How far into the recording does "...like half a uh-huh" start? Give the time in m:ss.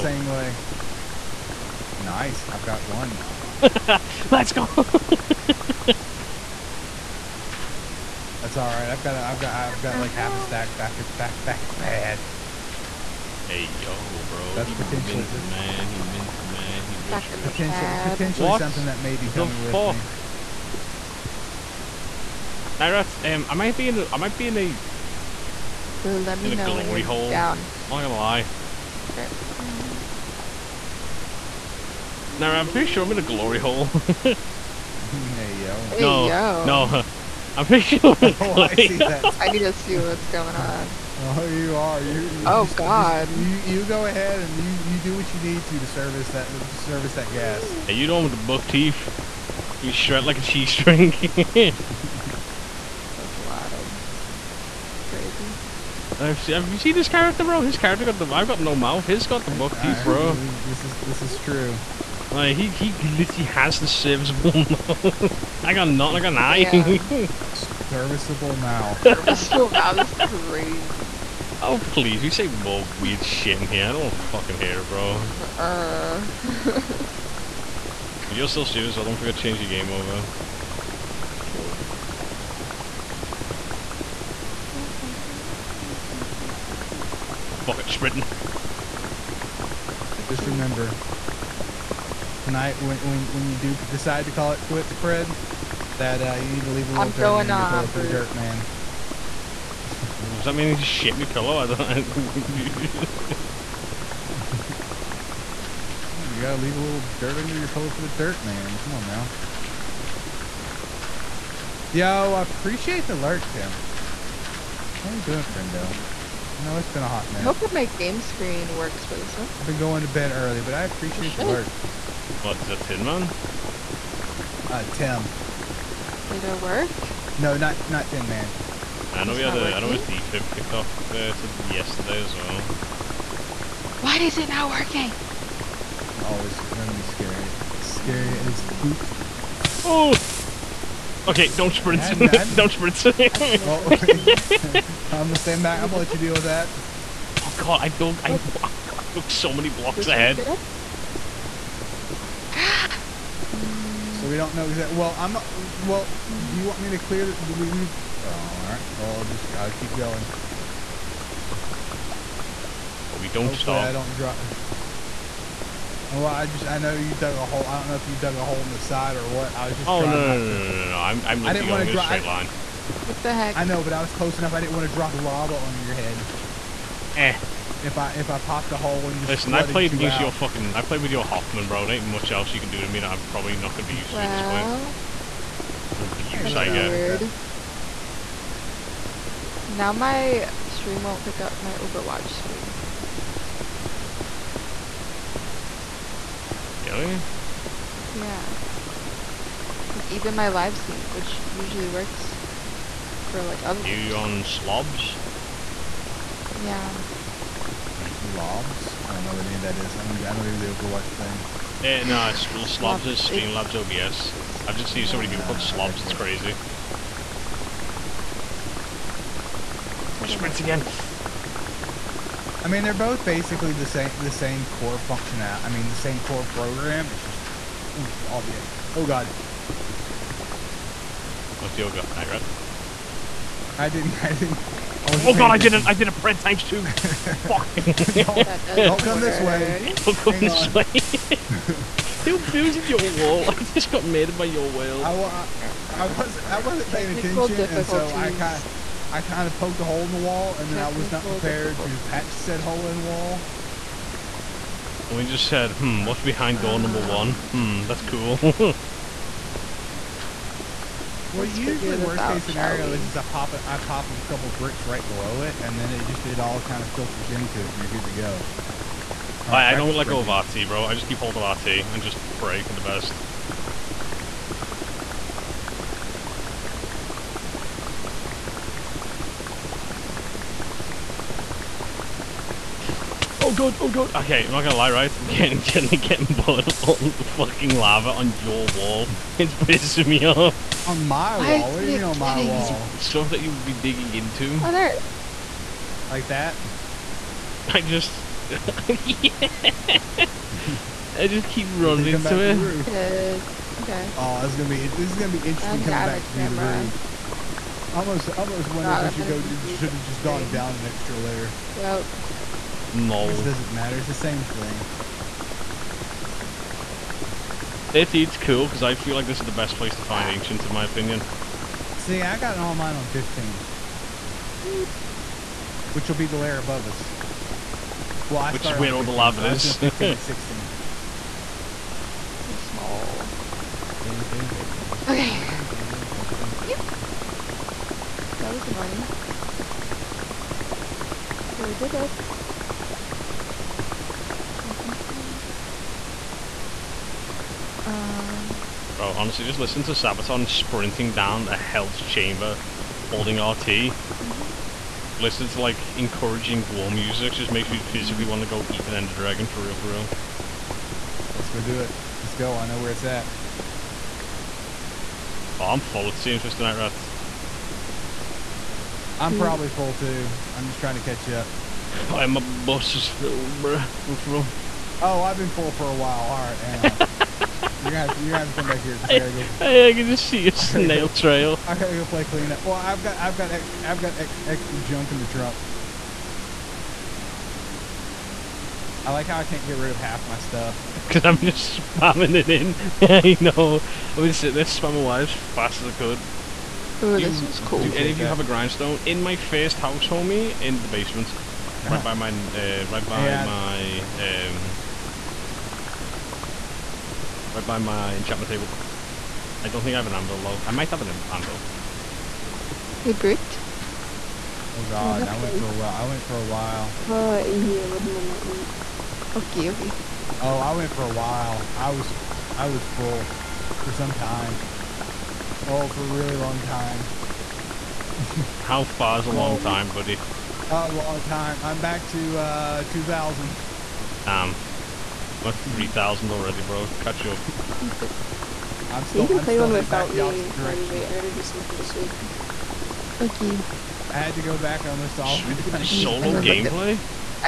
0:09.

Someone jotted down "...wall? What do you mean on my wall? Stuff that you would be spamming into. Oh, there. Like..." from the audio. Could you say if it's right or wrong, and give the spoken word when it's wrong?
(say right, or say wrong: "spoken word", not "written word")
wrong: "digging", not "spamming".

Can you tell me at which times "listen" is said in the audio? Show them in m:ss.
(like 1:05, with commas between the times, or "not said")
2:59, 5:49, 5:55.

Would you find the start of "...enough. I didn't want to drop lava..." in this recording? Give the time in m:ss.
2:54.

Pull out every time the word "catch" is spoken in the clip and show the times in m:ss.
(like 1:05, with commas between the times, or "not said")
6:11, 7:17.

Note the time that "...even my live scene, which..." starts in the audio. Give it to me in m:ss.
3:20.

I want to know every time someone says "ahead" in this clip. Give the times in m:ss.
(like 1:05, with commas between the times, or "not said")
0:44, 2:30.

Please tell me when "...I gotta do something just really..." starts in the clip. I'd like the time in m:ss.
7:21.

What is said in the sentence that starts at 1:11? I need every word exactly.
Oh please, you say more weird shit in here.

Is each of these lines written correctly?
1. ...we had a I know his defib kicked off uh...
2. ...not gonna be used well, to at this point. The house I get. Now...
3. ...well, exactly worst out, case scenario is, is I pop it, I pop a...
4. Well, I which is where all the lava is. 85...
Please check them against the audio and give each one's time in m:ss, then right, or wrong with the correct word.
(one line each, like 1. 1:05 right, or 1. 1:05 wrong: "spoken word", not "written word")
1. 2:09 right
2. 3:03 wrong: "abuse", not "house"
3. 4:21 wrong: "usually", not "exactly"
4. 5:28 wrong: "15", not "85".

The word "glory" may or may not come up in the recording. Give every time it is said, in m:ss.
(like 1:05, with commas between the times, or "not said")
0:26, 0:33.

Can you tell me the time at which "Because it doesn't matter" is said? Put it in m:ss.
5:13.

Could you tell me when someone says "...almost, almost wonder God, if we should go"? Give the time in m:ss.
5:07.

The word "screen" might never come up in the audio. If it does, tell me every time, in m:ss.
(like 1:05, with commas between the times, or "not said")
1:58, 3:12.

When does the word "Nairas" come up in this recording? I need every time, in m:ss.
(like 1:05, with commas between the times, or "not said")
0:22.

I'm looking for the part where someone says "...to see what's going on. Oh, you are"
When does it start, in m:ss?
0:39.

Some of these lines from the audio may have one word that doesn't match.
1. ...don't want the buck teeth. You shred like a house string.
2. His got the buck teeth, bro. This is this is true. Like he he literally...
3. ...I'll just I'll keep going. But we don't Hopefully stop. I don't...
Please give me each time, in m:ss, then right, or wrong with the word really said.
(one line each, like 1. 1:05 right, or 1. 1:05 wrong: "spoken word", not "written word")
1. 0:48 wrong: "cheese", not "house"
2. 0:59 right
3. 2:39 right.